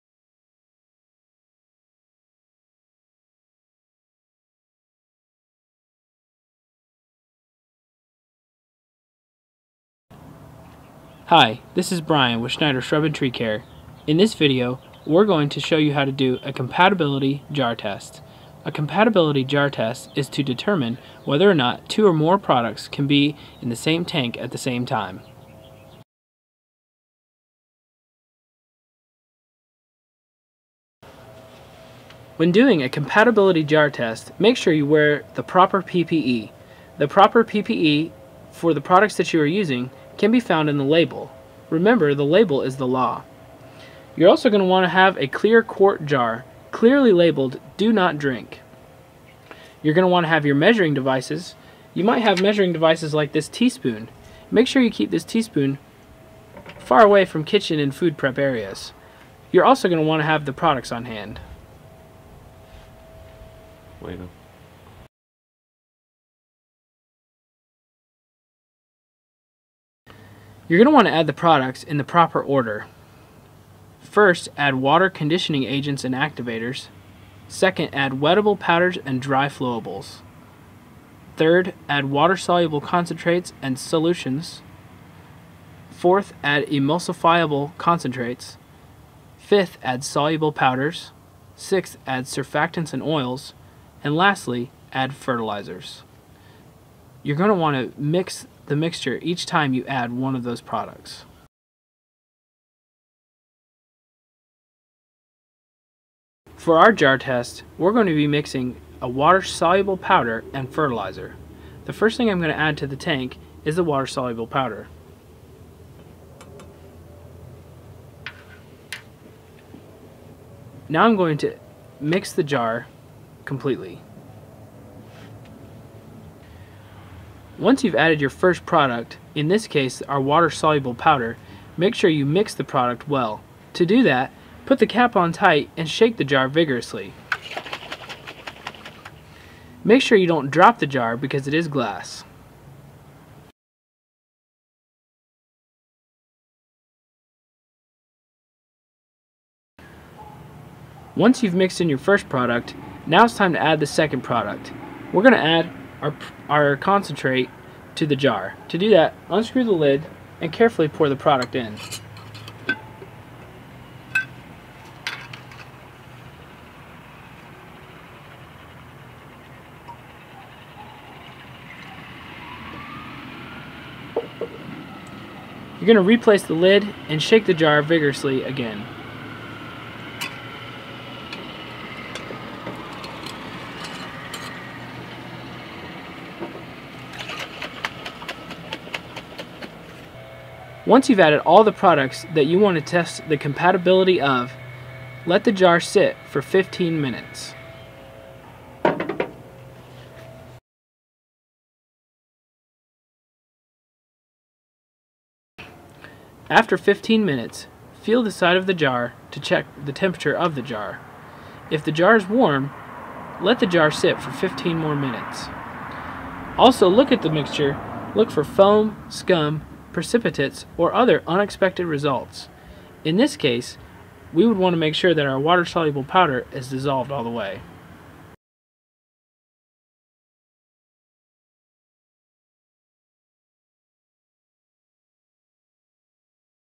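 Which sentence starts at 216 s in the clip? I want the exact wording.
Also look at the mixture, look for foam, scum, precipitates, or other unexpected results.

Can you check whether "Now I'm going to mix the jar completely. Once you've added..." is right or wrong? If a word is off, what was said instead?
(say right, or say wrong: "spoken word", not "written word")
right.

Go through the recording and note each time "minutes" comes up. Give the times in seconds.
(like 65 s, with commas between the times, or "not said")
64 s, 196 s, 207 s, 214 s.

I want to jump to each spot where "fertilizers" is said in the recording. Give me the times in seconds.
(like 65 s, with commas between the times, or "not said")
95 s, 110 s.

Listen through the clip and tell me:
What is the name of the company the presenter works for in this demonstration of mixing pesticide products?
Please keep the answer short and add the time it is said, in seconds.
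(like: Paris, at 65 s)
Schneider Shrub and Tree Care, at 12 s.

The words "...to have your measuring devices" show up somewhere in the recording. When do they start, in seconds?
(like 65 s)
50 s.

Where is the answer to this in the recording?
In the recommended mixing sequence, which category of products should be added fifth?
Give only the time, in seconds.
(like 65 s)
90 s.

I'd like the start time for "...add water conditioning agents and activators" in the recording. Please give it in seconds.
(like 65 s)
74 s.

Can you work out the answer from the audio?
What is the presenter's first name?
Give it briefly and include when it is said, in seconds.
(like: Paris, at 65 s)
Brian, at 12 s.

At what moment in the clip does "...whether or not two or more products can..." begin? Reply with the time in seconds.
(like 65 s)
21 s.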